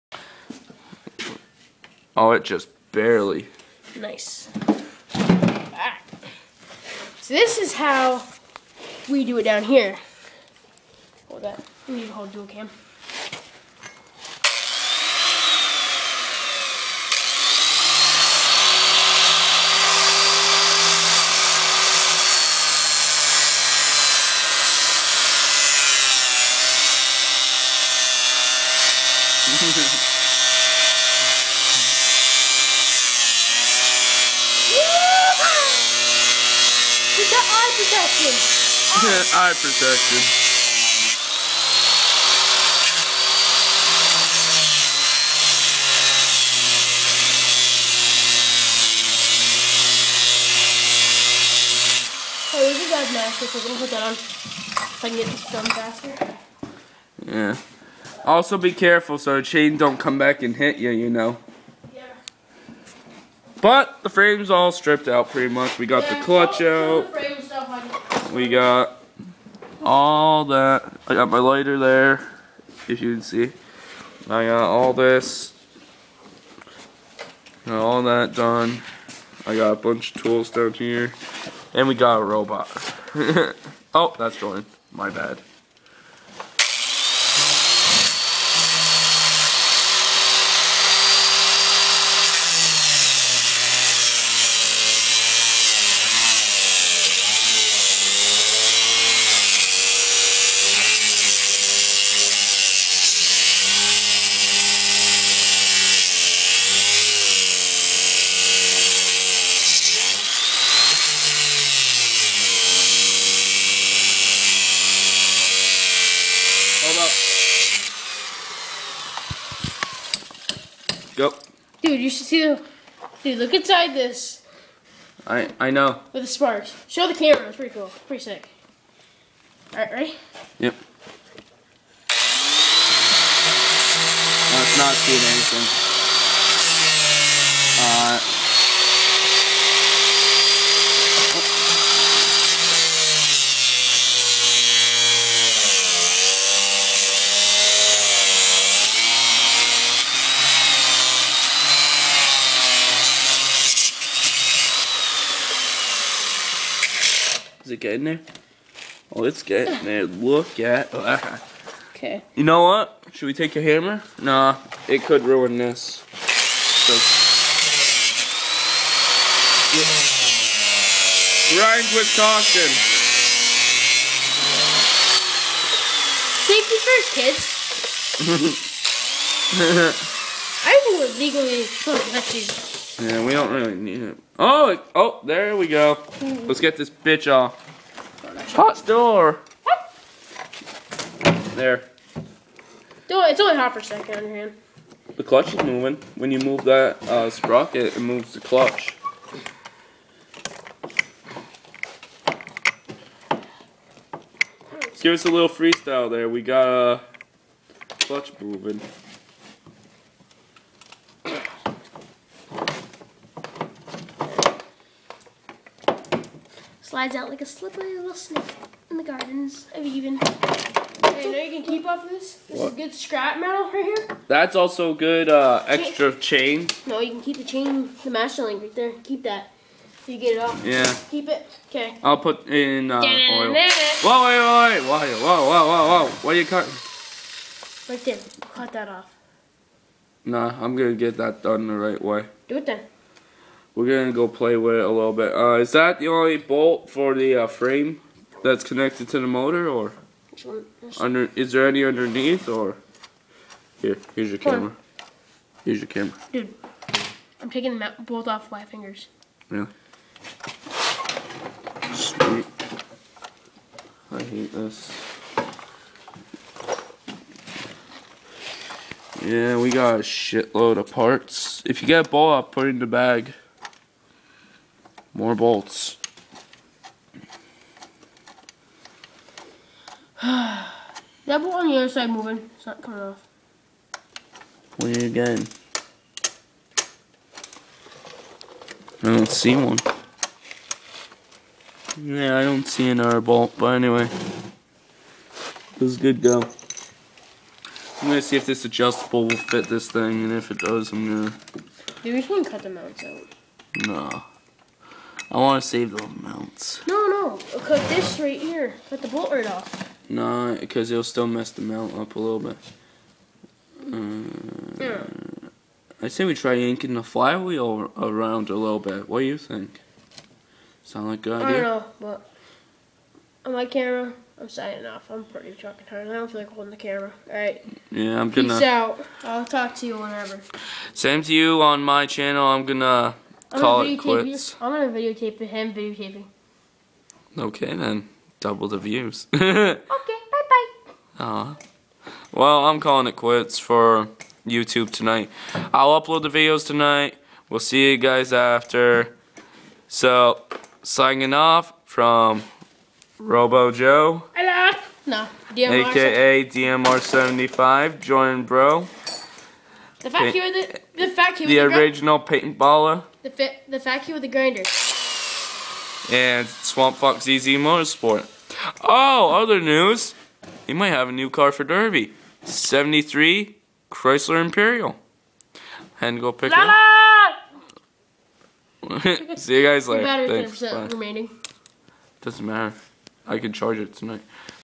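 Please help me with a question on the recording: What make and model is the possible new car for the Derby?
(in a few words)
Chrysler Imperial.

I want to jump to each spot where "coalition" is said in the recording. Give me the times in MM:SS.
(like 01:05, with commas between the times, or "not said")
not said.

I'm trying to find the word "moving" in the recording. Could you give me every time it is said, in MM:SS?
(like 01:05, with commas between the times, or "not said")
03:15, 03:28, 04:42.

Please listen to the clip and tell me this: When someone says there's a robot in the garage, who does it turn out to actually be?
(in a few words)
Jordan.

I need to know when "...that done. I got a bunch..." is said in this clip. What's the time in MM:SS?
01:18.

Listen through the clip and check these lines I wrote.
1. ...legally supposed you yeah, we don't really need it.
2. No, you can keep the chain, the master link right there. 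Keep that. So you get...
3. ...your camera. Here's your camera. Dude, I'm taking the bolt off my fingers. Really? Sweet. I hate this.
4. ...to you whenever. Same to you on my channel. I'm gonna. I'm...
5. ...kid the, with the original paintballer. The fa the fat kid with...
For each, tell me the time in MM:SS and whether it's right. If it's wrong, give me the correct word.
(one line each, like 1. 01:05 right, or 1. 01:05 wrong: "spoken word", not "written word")
1. 03:01 right
2. 03:46 right
3. 04:14 right
4. 05:29 right
5. 06:01 right.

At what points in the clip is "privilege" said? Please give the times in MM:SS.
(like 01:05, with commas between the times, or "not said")
not said.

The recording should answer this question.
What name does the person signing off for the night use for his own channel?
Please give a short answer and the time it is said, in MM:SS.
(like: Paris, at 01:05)
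Robo Joe, at 05:53.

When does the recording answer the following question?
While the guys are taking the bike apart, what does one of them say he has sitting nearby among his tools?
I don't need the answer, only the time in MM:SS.
01:11.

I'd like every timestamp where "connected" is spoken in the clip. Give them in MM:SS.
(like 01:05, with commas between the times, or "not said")
04:08.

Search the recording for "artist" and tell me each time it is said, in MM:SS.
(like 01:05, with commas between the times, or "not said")
not said.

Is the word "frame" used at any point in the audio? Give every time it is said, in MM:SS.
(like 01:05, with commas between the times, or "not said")
01:04, 04:07.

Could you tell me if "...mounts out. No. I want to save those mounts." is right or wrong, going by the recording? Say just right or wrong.
right.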